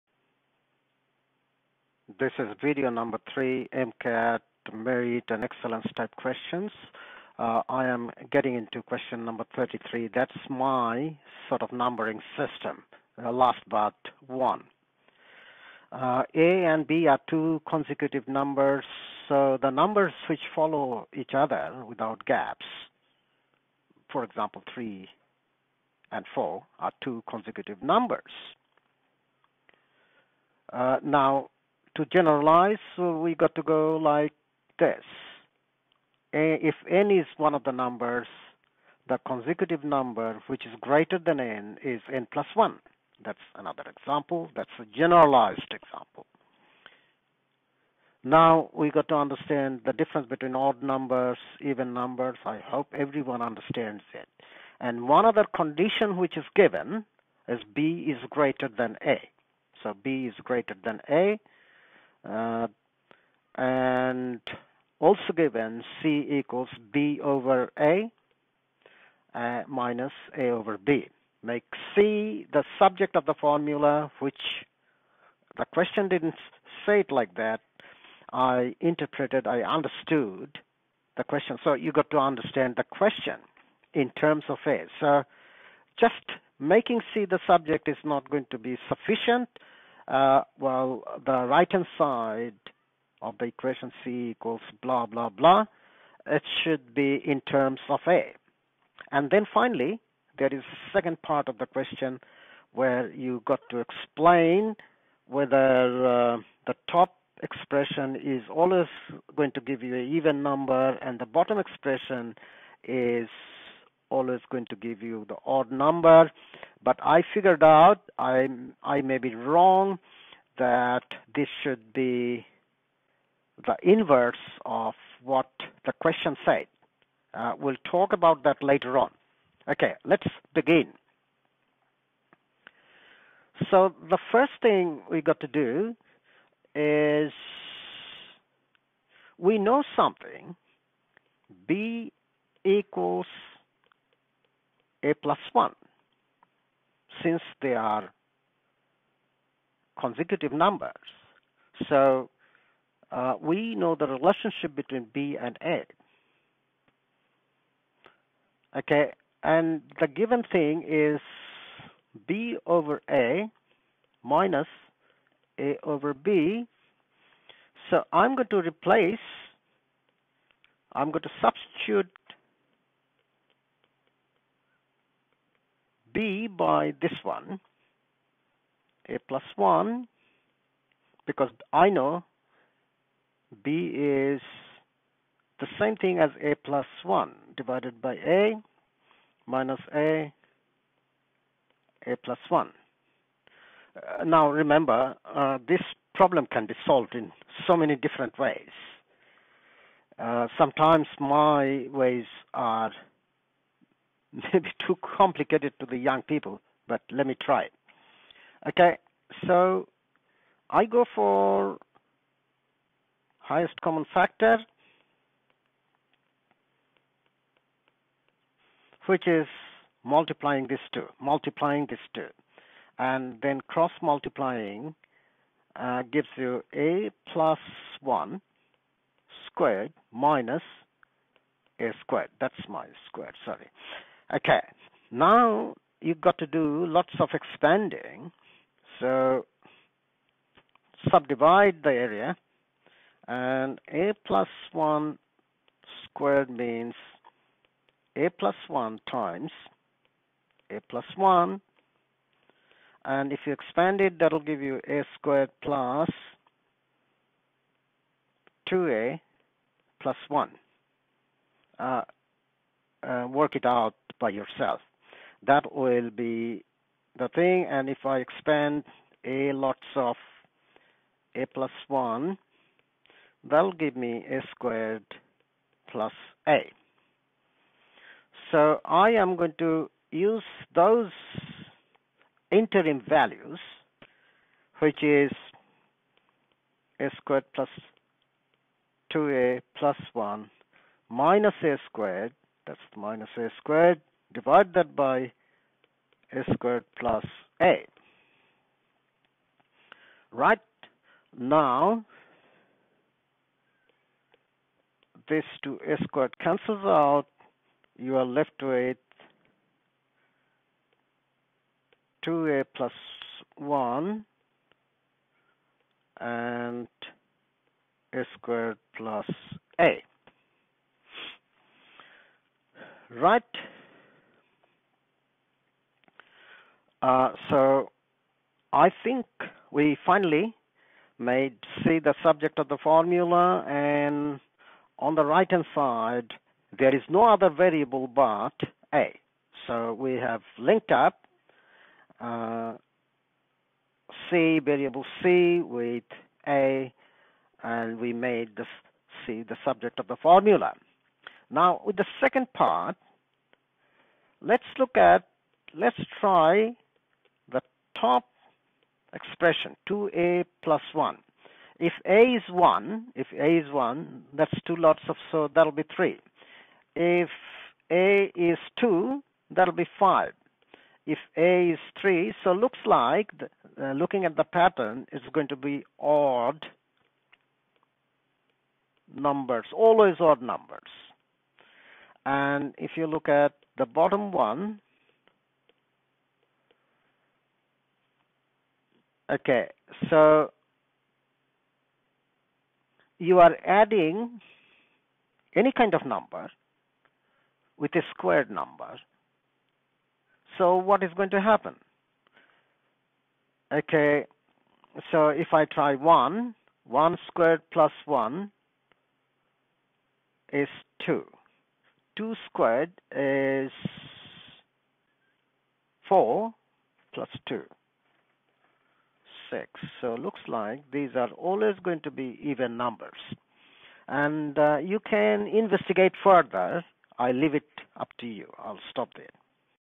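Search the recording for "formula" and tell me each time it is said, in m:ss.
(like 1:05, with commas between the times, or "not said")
1:13, 5:32, 5:50.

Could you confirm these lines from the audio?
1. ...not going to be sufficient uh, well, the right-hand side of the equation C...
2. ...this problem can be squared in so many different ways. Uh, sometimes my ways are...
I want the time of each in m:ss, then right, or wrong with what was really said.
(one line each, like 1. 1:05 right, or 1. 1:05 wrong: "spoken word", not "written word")
1. 1:28 right
2. 3:15 wrong: "solved", not "squared".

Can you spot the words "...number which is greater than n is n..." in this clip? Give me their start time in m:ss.
0:39.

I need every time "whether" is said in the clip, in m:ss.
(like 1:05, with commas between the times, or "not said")
1:45.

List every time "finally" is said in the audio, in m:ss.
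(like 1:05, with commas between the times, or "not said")
1:39, 5:30.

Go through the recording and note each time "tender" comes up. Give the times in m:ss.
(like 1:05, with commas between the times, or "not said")
not said.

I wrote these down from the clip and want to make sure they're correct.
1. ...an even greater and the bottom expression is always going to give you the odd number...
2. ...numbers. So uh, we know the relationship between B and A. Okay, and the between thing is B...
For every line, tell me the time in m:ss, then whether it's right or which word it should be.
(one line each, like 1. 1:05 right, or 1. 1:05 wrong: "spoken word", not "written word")
1. 1:49 wrong: "number", not "greater"
2. 2:30 wrong: "given", not "between".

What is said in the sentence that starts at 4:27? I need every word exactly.
And if I expand a lots of a plus 1, that'll give me a squared plus a.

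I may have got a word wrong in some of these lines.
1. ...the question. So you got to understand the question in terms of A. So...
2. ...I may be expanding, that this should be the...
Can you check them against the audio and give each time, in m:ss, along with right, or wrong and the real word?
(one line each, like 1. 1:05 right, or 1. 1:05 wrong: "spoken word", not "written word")
1. 1:21 right
2. 1:58 wrong: "wrong", not "expanding".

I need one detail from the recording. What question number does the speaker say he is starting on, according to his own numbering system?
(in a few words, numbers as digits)
33.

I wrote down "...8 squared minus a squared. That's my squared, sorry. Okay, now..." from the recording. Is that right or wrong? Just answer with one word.
wrong.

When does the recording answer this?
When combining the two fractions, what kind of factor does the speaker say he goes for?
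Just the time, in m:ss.
3:33.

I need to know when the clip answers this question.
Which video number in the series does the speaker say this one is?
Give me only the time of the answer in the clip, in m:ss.
0:03.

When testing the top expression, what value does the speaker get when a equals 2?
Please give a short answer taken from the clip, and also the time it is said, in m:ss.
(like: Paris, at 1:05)
5, at 6:09.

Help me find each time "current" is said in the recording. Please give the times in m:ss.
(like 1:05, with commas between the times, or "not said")
not said.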